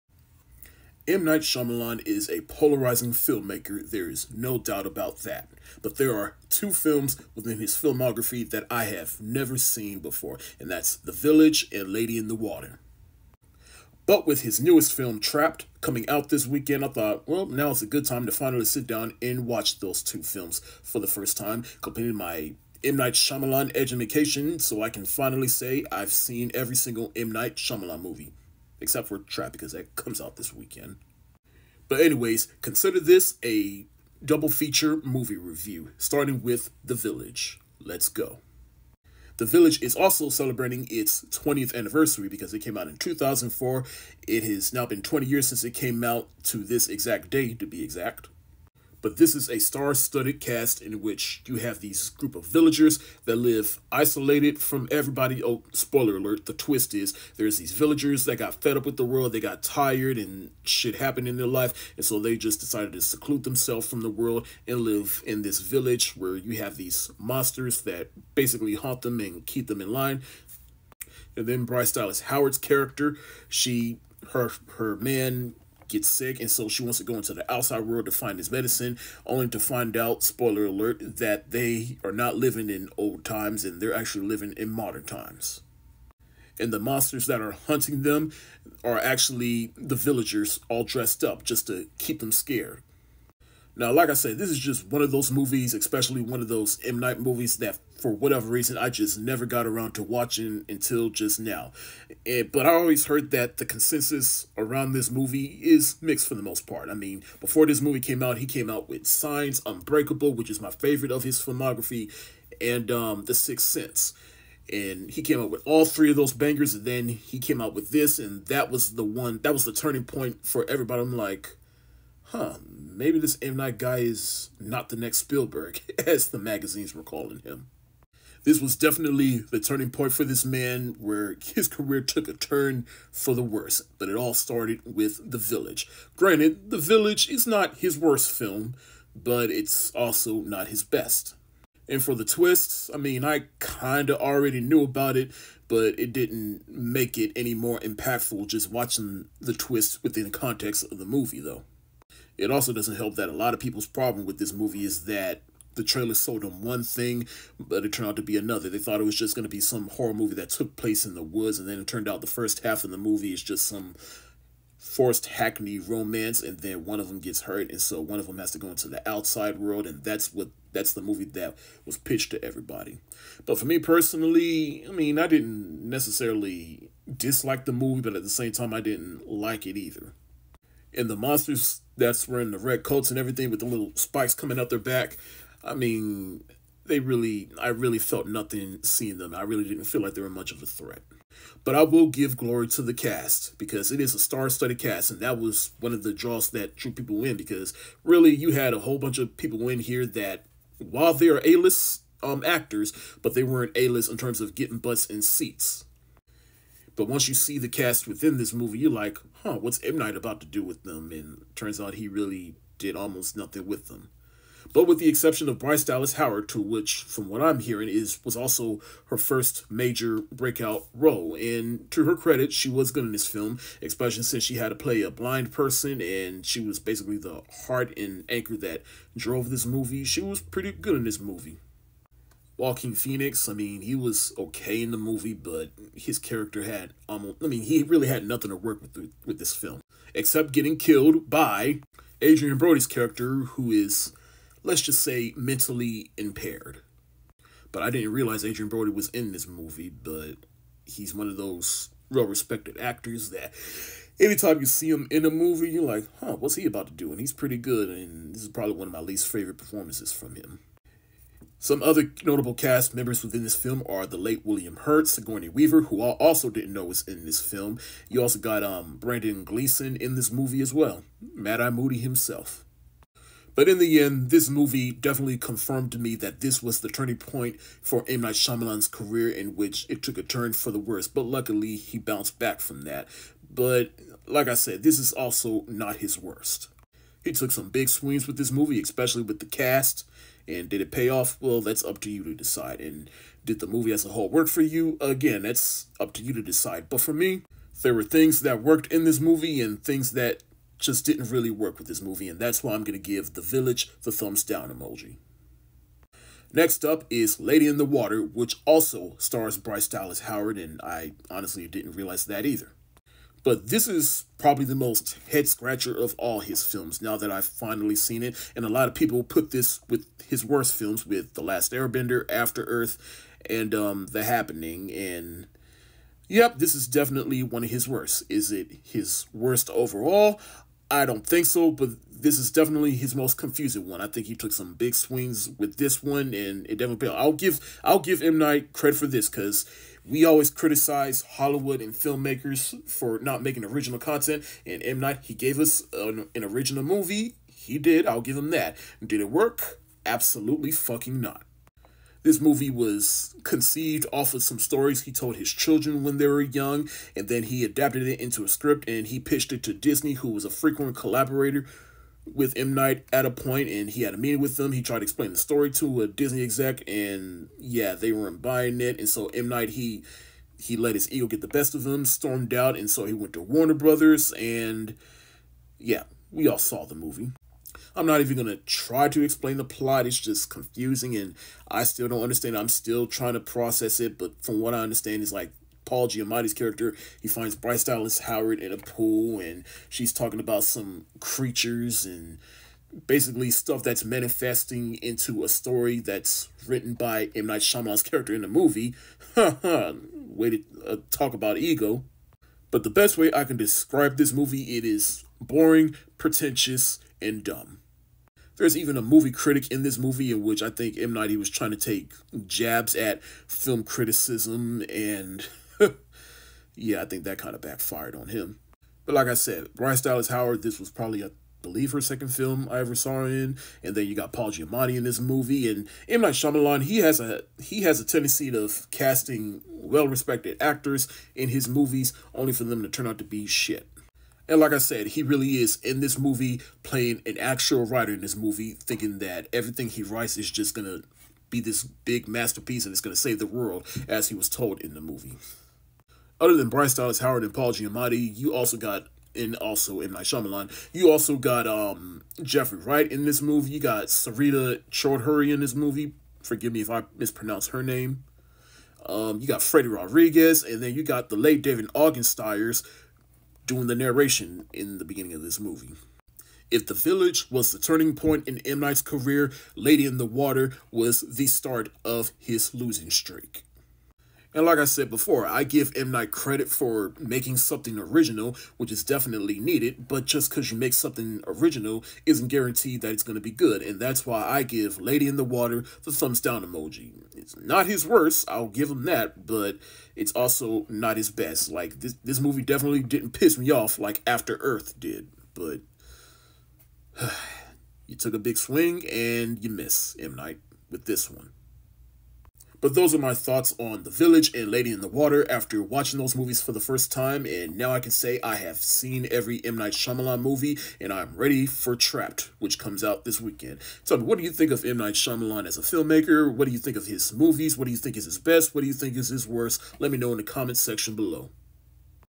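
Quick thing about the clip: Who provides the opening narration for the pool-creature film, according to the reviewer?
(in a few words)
David Ogden Stiers.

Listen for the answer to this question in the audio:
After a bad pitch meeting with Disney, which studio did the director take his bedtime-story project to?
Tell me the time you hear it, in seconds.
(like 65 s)
373 s.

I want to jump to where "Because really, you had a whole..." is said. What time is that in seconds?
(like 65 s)
197 s.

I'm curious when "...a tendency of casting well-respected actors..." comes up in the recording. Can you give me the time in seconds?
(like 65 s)
427 s.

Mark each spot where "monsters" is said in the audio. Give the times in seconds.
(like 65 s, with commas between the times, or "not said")
67 s, 86 s, 181 s.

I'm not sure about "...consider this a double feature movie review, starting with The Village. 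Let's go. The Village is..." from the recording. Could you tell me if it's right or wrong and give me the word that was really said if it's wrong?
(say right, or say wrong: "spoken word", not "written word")
right.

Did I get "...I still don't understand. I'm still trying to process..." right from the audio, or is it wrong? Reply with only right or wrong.
right.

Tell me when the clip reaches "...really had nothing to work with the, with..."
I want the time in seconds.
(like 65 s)
237 s.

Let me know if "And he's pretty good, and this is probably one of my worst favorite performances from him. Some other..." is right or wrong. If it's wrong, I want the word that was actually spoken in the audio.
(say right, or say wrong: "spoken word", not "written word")
wrong: "least", not "worst".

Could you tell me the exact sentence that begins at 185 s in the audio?
I mean, they really, I really felt nothing seeing them.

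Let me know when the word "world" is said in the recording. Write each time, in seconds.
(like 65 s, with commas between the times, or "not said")
59 s, 64 s, 77 s, 169 s, 443 s.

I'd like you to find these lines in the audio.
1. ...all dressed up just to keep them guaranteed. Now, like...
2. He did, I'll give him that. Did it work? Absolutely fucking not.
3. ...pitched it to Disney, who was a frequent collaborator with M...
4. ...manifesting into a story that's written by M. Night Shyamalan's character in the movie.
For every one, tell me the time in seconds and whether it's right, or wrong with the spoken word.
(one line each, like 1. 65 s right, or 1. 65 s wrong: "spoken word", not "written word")
1. 90 s wrong: "scared", not "guaranteed"
2. 347 s right
3. 359 s right
4. 394 s right.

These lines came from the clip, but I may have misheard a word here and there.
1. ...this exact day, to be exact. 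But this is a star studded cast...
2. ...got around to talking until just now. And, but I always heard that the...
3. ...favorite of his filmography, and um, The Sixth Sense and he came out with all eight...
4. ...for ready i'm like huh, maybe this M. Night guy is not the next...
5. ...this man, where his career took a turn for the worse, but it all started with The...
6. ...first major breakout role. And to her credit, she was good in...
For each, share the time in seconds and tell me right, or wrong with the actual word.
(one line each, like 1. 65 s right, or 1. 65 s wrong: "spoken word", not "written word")
1. 46 s right
2. 99 s wrong: "watching", not "talking"
3. 110 s wrong: "three", not "eight"
4. 120 s wrong: "everybody", not "ready"
5. 130 s right
6. 219 s right.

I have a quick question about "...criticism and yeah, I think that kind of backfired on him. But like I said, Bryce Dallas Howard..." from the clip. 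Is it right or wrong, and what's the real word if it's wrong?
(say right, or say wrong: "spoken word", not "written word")
right.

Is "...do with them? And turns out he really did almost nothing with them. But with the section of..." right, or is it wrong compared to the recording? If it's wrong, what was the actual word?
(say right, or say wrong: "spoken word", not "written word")
wrong: "exception", not "section".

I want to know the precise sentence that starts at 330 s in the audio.
I don't think so, but this is definitely his most confusing one.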